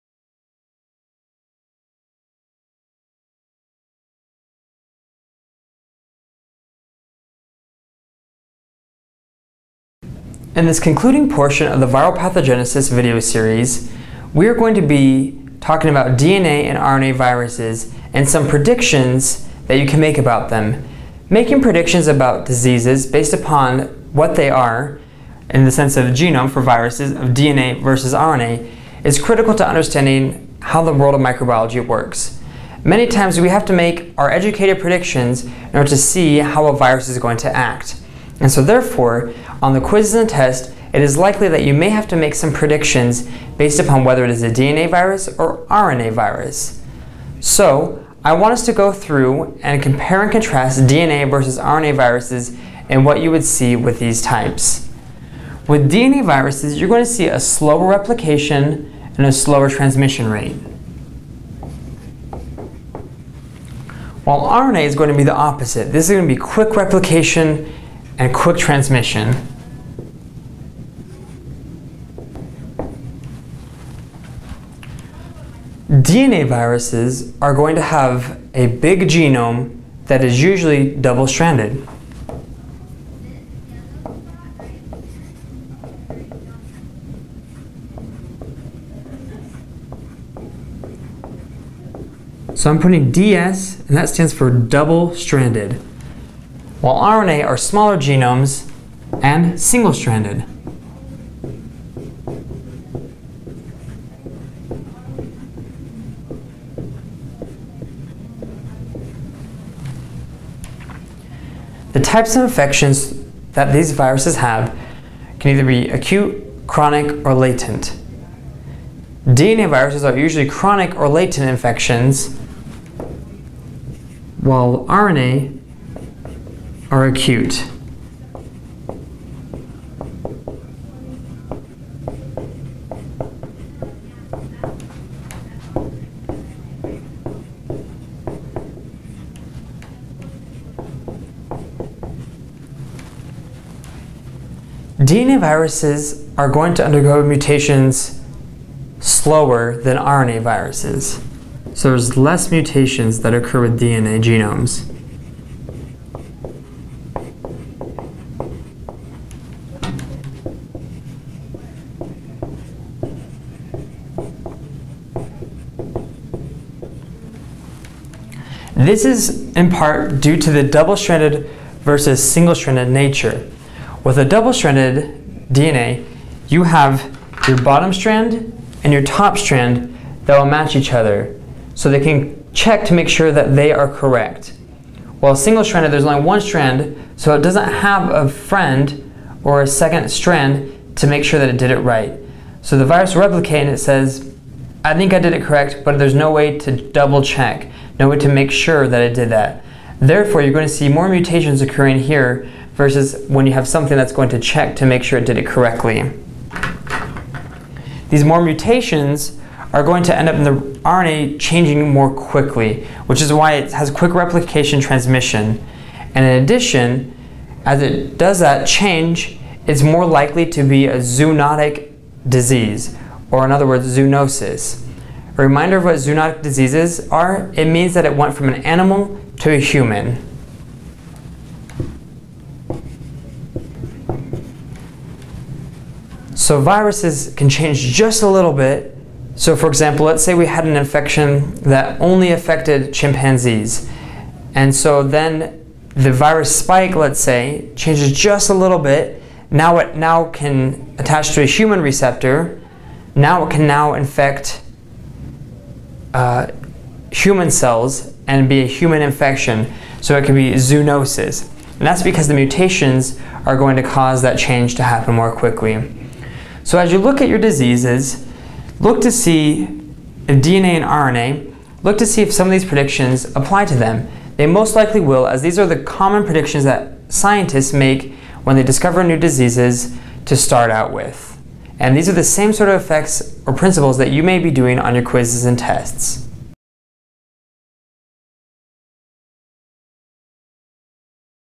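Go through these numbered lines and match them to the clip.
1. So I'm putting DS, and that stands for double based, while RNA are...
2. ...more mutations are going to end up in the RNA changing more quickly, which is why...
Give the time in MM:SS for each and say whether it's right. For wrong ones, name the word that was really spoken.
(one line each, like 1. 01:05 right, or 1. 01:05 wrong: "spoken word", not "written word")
1. 01:32 wrong: "stranded", not "based"
2. 03:28 right.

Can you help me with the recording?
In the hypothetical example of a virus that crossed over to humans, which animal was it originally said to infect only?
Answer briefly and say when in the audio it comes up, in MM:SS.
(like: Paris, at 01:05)
chimpanzees, at 04:02.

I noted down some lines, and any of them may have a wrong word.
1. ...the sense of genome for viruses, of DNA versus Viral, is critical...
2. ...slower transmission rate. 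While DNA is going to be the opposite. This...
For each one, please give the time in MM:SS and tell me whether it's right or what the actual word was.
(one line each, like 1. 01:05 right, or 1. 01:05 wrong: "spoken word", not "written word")
1. 00:25 wrong: "RNA", not "Viral"
2. 00:59 wrong: "RNA", not "DNA".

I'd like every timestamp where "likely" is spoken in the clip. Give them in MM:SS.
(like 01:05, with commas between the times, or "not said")
00:41, 03:40, 04:34.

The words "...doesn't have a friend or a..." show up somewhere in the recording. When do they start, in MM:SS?
03:07.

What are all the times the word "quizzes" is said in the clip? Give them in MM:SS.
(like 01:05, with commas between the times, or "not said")
00:39, 04:45.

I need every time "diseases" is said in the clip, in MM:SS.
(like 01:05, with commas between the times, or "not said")
00:22, 03:42, 03:46, 04:27, 04:39.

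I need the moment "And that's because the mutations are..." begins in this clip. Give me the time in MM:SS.
04:21.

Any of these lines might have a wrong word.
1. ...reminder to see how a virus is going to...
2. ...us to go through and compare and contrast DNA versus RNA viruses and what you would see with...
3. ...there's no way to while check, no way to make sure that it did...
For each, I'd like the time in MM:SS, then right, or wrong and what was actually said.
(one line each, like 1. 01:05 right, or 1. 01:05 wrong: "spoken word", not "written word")
1. 00:35 wrong: "order", not "reminder"
2. 00:48 right
3. 03:15 wrong: "double", not "while".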